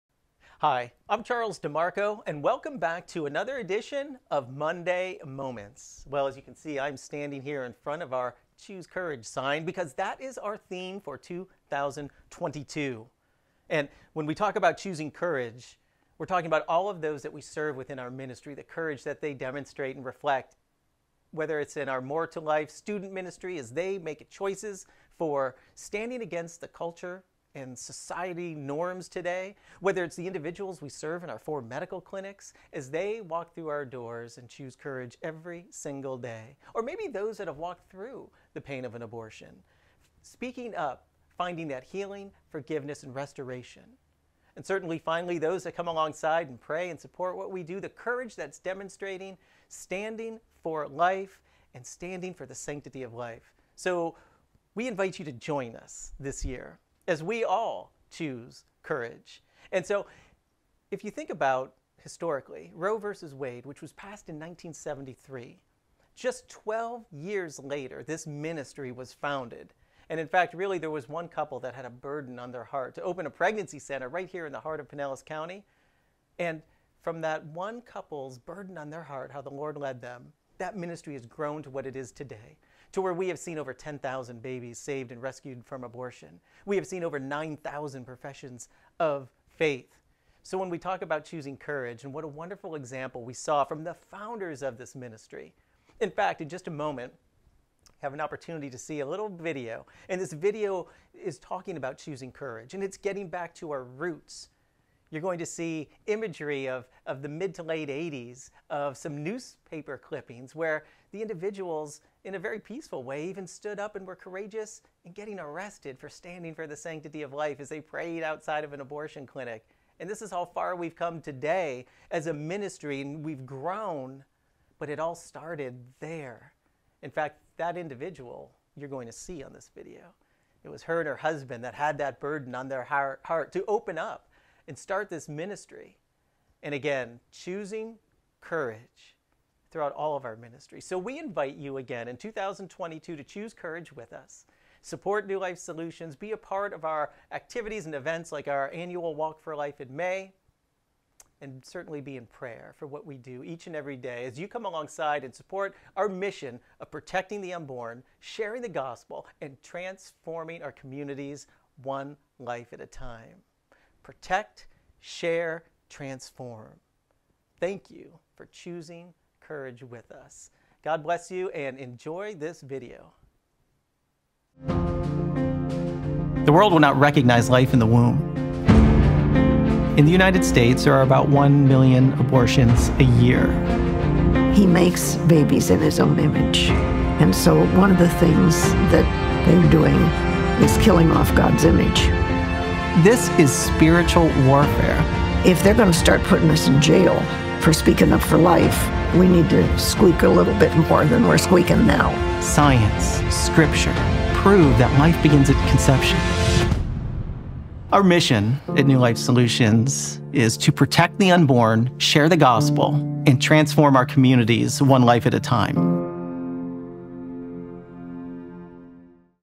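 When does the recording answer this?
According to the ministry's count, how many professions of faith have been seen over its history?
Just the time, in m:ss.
1:27.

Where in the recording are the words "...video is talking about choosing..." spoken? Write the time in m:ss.
1:40.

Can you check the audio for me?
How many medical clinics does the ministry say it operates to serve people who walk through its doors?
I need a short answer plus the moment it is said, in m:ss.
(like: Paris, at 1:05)
4, at 0:31.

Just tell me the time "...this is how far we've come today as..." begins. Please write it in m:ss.
2:00.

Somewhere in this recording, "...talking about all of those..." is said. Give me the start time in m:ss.
0:16.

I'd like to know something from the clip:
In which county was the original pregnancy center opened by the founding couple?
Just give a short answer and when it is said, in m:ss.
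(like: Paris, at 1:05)
Pinellas County, at 1:14.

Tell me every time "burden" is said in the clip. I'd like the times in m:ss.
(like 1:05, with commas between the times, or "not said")
1:11, 1:18, 2:12.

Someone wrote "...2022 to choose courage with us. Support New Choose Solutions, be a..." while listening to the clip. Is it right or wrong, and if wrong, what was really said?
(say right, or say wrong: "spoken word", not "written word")
wrong: "Life", not "Choose".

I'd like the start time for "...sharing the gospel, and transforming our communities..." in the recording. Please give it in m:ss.
2:38.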